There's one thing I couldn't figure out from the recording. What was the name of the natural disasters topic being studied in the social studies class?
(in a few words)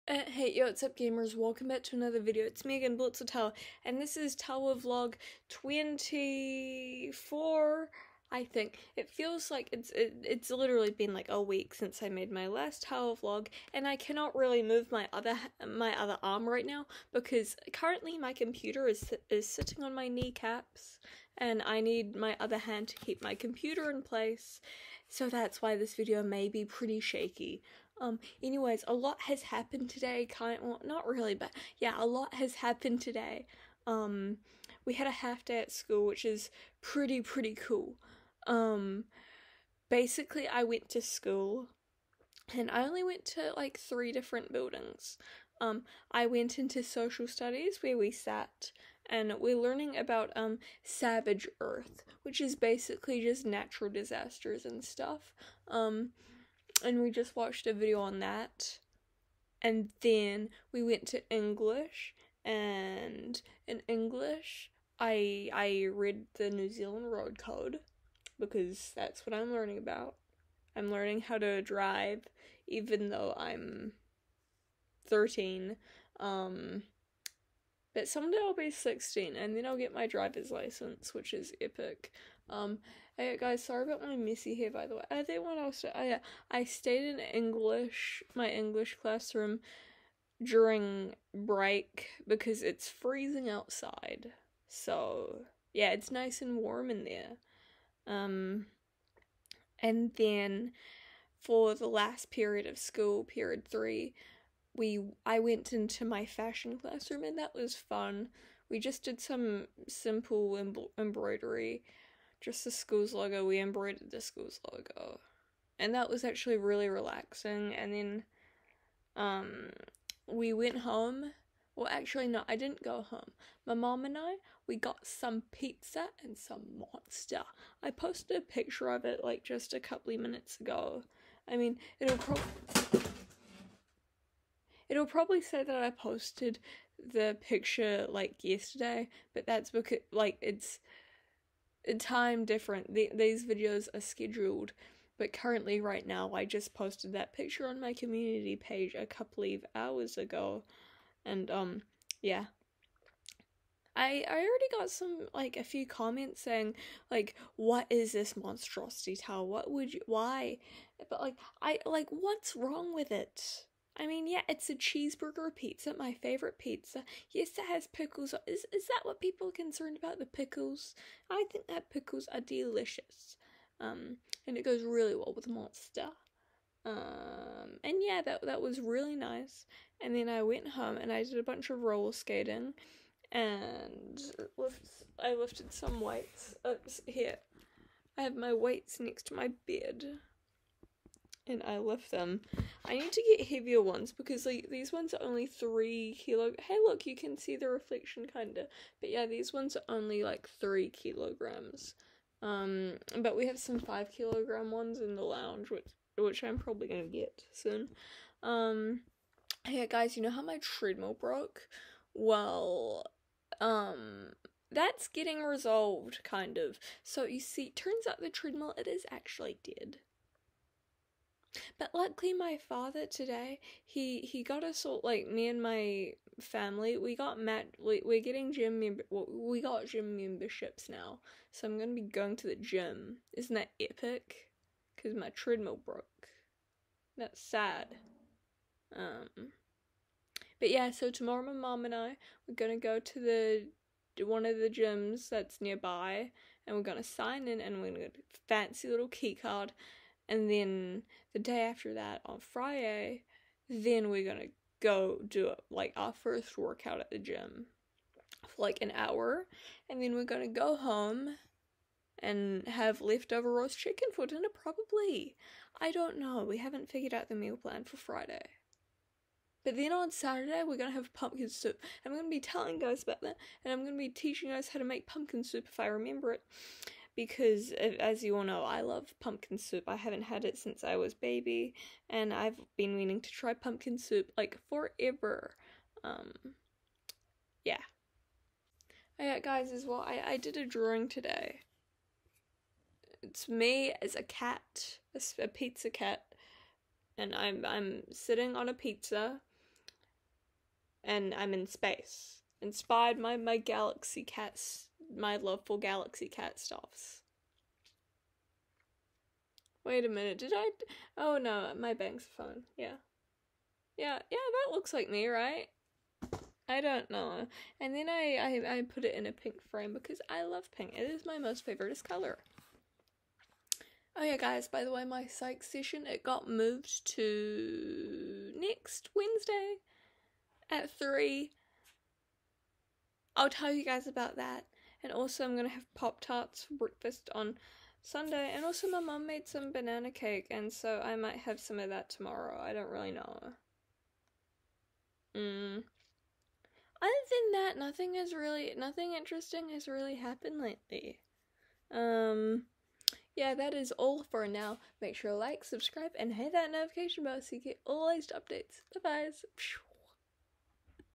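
Savage Earth.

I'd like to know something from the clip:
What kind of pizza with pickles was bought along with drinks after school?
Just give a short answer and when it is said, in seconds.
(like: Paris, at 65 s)
Cheeseburger pizza, at 164 s.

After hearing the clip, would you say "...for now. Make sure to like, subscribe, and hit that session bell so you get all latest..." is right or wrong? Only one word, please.
wrong.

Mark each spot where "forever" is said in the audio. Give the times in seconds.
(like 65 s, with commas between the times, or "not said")
284 s.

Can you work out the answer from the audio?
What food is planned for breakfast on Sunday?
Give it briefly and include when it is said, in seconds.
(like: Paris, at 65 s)
Pop Tarts, at 335 s.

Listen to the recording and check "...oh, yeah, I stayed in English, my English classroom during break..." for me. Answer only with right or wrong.
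right.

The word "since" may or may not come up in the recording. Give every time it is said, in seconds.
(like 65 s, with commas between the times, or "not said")
11 s, 280 s.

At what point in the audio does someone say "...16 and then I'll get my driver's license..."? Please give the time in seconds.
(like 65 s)
78 s.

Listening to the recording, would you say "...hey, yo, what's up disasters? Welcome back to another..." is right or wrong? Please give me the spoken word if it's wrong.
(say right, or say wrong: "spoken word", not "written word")
wrong: "gamers", not "disasters".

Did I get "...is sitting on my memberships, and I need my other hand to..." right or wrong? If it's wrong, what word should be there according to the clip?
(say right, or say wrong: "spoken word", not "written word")
wrong: "kneecaps", not "memberships".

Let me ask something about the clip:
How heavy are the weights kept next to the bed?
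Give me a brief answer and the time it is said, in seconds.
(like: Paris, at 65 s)
3 kilograms, at 195 s.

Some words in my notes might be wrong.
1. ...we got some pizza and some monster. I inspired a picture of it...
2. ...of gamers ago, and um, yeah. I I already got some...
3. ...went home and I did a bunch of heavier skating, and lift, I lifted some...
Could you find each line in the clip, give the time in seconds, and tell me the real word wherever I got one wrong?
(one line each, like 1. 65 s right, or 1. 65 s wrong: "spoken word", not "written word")
1. 124 s wrong: "posted", not "inspired"
2. 149 s wrong: "hours", not "gamers"
3. 180 s wrong: "roller", not "heavier".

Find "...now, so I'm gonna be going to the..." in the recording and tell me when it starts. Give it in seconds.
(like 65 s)
230 s.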